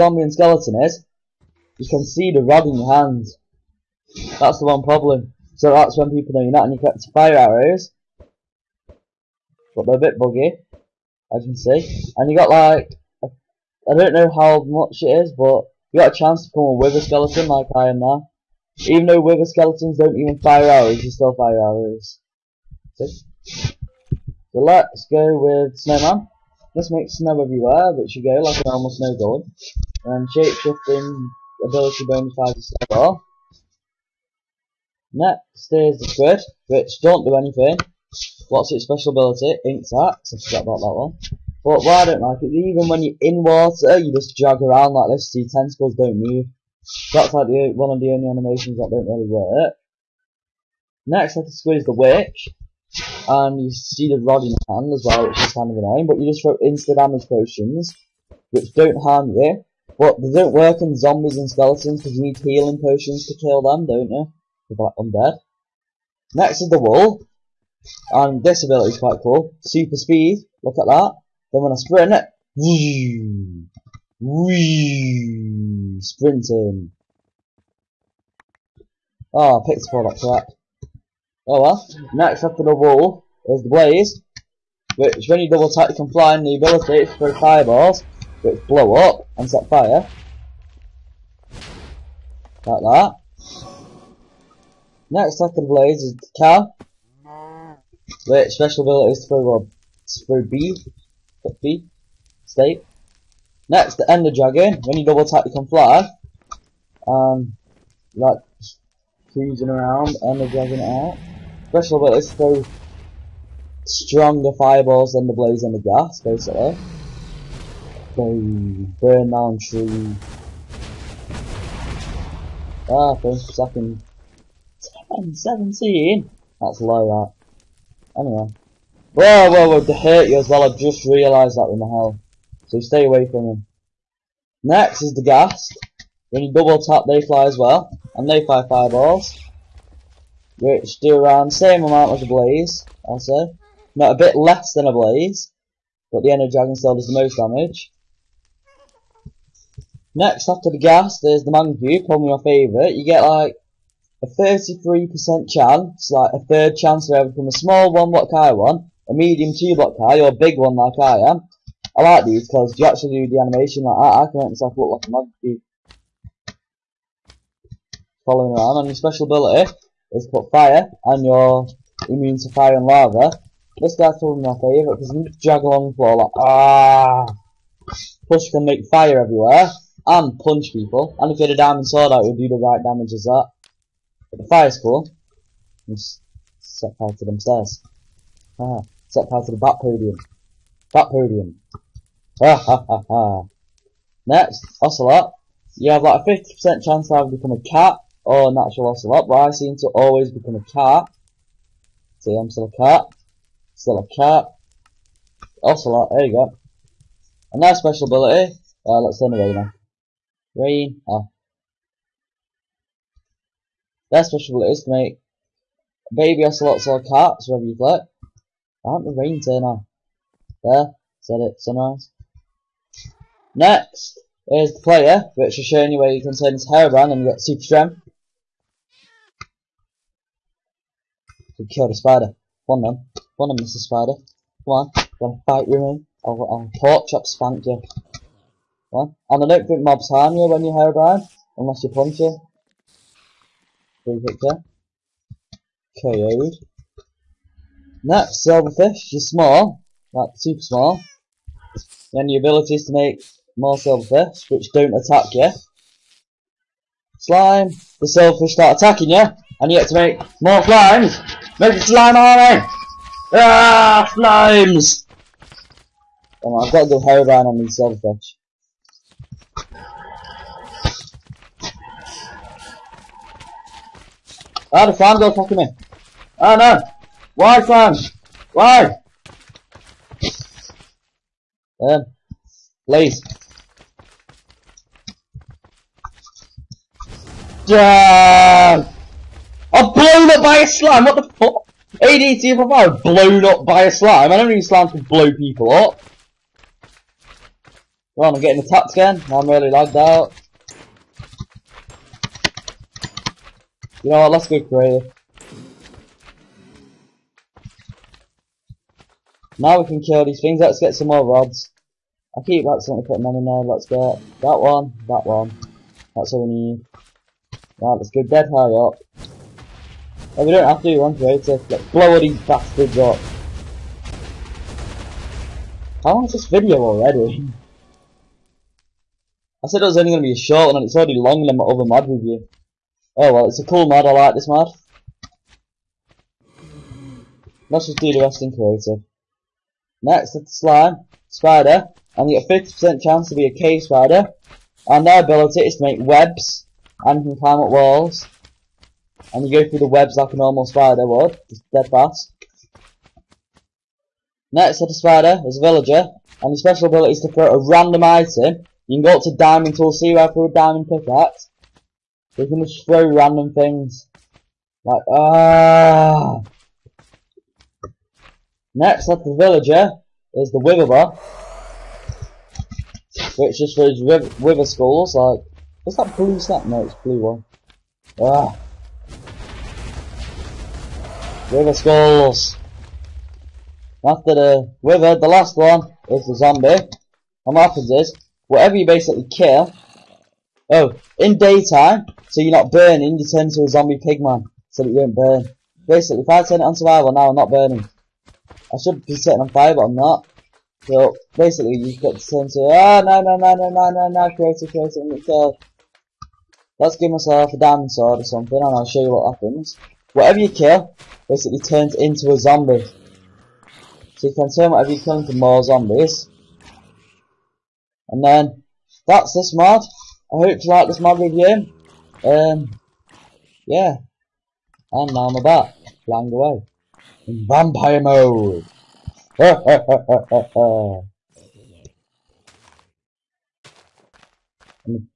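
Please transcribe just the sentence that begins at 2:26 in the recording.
But the Ender Dragon still does the most damage.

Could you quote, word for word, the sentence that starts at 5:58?
You can go up to diamond tool, see where through a diamond pickaxe, they're gonna throw random things.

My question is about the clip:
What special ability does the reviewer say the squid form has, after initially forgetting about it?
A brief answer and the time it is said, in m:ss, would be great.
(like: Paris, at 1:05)
Ink sacks, at 0:39.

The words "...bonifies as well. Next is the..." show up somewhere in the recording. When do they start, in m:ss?
0:32.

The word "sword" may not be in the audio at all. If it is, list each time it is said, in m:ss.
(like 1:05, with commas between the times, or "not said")
3:01, 6:47.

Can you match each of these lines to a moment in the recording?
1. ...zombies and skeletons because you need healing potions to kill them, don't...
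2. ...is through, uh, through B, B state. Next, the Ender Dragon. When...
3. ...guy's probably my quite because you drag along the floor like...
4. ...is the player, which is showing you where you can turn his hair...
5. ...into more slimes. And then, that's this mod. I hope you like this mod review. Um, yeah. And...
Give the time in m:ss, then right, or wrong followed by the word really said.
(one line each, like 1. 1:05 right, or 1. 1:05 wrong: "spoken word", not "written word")
1. 1:00 right
2. 1:39 right
3. 2:53 wrong: "favourite", not "quite"
4. 3:44 right
5. 6:55 wrong: "zombies", not "slimes".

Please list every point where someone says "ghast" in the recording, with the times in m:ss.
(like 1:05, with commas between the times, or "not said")
1:55, 2:15, 2:30.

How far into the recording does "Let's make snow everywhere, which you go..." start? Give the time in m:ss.
0:26.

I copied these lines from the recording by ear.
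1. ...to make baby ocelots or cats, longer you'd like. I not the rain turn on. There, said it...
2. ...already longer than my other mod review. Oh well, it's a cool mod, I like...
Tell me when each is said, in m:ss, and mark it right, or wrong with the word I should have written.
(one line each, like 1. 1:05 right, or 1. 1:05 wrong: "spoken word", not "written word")
1. 3:34 wrong: "whatever", not "longer"
2. 5:30 right.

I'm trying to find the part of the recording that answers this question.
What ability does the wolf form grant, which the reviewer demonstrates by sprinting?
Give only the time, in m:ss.
1:09.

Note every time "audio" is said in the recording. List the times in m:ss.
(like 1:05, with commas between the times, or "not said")
not said.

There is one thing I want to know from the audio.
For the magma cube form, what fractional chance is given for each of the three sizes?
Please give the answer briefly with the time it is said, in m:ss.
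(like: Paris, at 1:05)
A third, at 2:36.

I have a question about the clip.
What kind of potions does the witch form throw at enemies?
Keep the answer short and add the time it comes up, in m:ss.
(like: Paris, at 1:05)
Instant damage potions, at 0:56.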